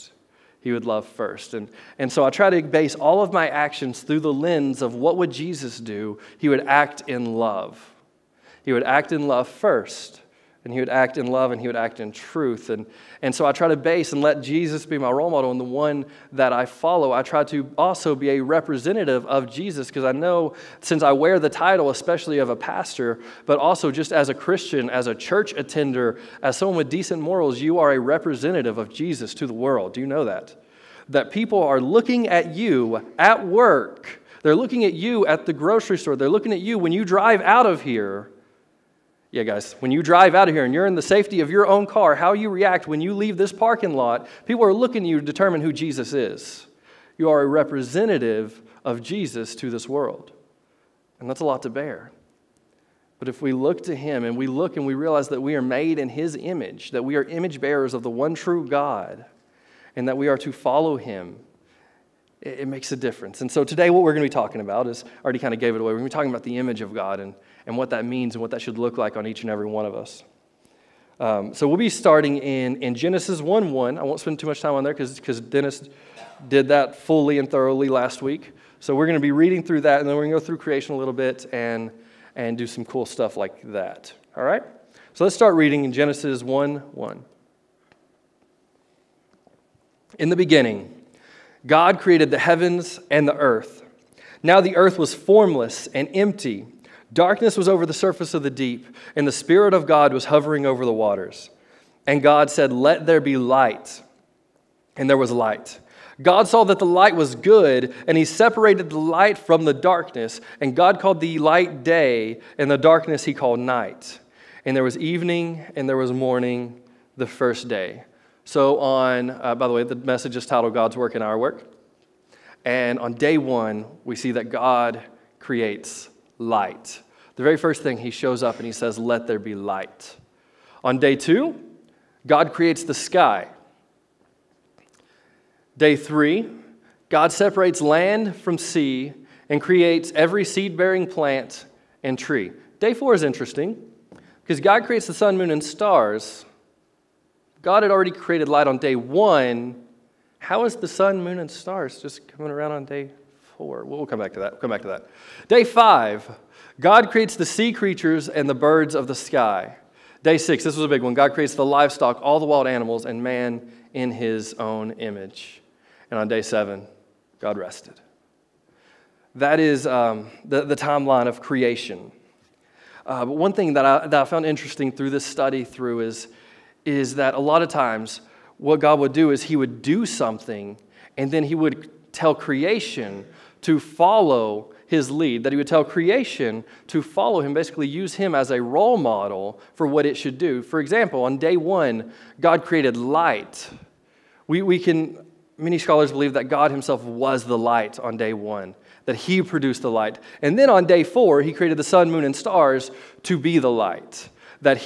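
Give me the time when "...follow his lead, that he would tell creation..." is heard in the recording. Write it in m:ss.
3:03.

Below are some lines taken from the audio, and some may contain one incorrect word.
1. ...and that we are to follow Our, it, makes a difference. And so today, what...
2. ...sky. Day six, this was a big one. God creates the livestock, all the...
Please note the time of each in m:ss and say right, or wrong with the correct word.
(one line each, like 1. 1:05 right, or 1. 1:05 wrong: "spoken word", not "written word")
1. 0:59 wrong: "Him", not "Our"
2. 2:39 right.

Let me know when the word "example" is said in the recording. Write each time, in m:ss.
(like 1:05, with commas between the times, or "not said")
3:10.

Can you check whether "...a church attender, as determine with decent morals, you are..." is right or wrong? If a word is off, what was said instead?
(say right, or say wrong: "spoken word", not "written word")
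wrong: "someone", not "determine".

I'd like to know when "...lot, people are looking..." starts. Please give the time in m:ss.
0:43.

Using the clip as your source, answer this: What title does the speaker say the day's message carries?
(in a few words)
God's Work and Our Work.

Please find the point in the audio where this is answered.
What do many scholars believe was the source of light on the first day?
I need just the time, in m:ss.
3:16.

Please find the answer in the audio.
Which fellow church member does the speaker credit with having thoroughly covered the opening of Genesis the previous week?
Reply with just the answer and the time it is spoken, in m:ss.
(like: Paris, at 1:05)
Dennis, at 1:15.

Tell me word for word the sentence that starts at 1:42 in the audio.
And God said, Let there be light.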